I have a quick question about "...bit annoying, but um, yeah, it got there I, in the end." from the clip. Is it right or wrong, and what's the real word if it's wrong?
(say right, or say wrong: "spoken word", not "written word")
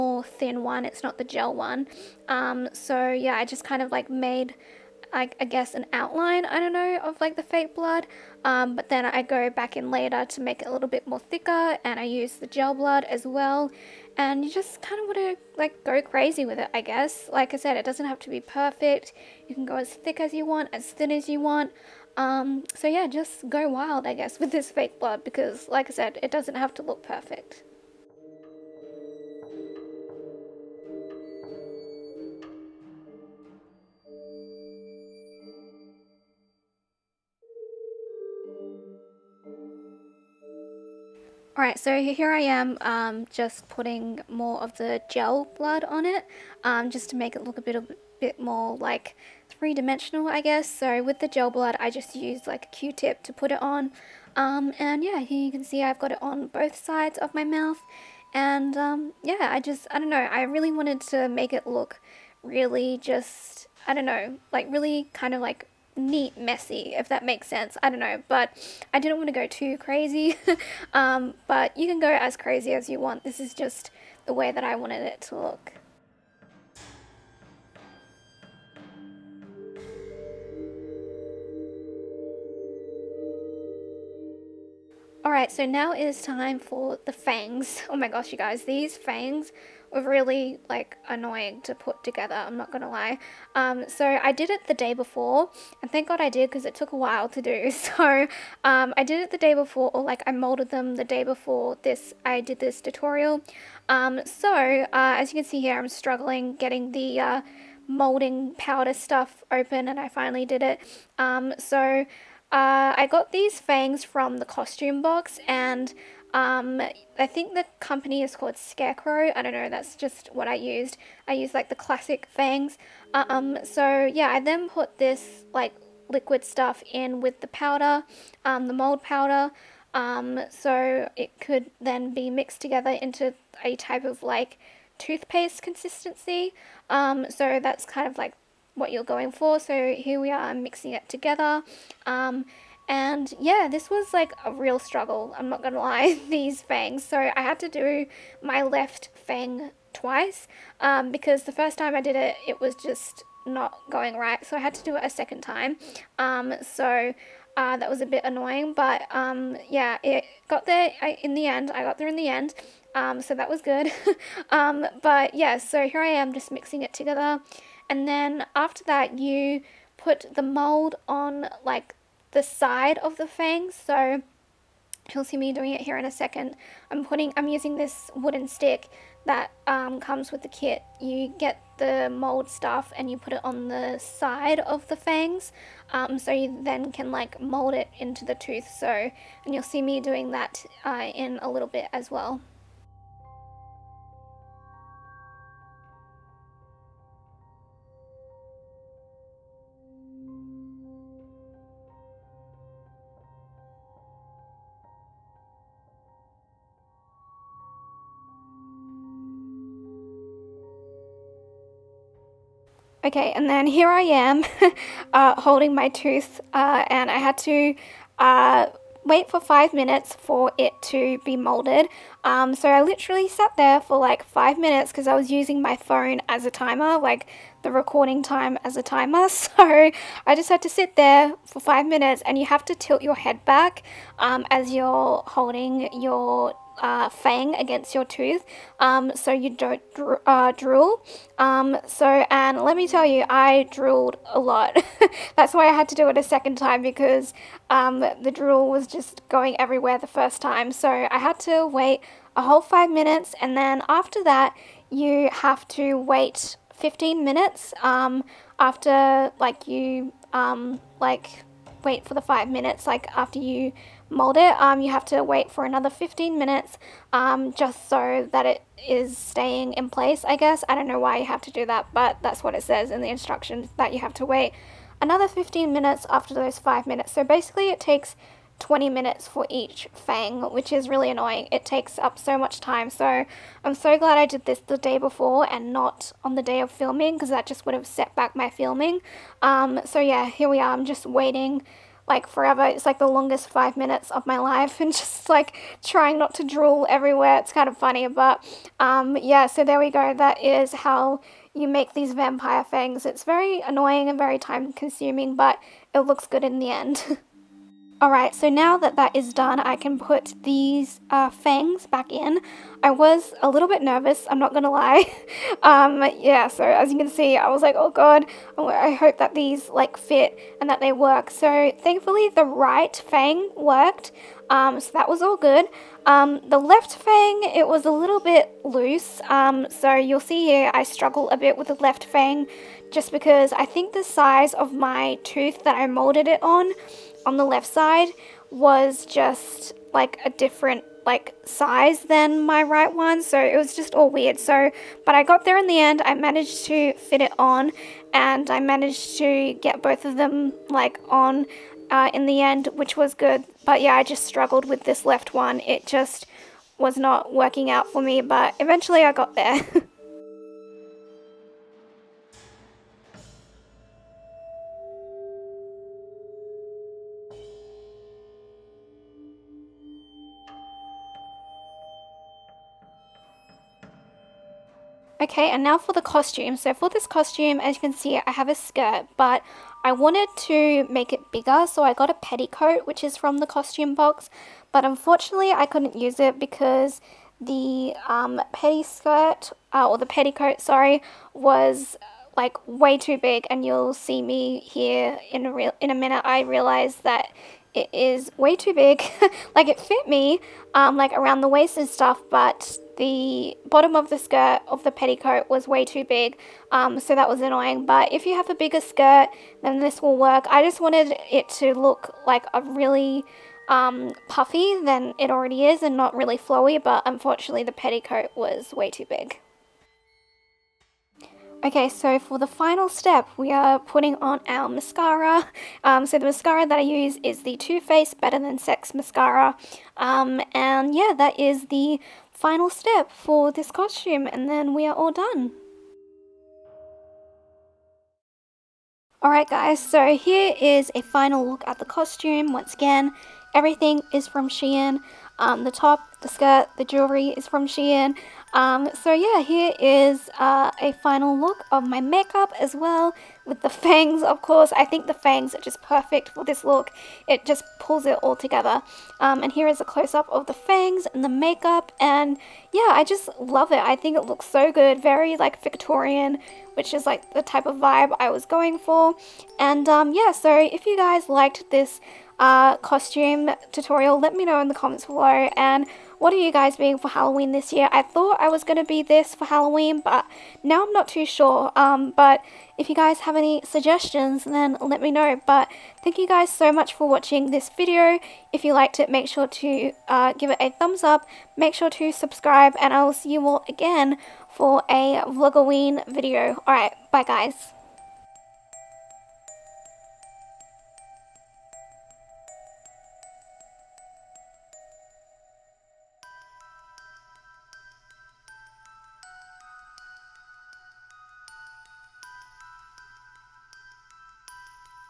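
right.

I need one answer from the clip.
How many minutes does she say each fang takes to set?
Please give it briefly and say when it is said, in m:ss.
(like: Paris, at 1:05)
20, at 4:38.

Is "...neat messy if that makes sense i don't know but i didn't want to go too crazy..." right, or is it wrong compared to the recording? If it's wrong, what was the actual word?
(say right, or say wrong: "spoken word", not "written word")
right.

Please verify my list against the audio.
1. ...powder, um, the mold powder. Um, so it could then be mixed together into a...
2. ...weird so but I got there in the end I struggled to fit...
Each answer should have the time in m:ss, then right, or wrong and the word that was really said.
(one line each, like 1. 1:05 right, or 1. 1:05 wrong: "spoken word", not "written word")
1. 2:07 right
2. 5:44 wrong: "managed", not "struggled".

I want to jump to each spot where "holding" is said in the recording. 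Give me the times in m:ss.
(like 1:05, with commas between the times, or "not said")
3:35, 3:55.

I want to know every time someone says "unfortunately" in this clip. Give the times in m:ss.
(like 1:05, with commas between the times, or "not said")
6:24, 6:57.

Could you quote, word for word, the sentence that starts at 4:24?
Um, you have to wait for another 15 minutes um, just so that it is staying in place, I guess.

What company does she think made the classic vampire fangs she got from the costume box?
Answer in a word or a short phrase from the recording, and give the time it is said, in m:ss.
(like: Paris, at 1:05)
Scarecrow, at 1:58.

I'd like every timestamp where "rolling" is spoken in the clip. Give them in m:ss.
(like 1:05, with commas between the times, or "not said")
not said.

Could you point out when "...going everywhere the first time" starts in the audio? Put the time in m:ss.
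4:09.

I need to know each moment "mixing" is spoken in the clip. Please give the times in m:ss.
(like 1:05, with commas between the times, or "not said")
2:20, 2:46.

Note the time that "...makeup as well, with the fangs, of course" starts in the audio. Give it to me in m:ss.
7:32.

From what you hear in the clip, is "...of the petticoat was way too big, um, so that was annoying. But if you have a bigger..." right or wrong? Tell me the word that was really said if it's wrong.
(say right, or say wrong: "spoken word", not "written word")
right.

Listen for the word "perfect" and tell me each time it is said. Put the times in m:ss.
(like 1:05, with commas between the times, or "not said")
0:18, 0:27, 7:35.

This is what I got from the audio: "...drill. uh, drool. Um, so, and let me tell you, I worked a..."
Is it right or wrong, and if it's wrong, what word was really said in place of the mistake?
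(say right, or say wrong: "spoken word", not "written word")
wrong: "drooled", not "worked".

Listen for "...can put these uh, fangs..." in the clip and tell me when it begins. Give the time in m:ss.
5:09.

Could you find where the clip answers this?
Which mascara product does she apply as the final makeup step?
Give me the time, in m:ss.
7:07.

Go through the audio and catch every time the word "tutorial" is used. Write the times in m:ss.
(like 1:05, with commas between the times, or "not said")
1:42, 7:53.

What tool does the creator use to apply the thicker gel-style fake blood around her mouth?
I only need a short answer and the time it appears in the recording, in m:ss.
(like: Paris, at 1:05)
Q-tip, at 0:52.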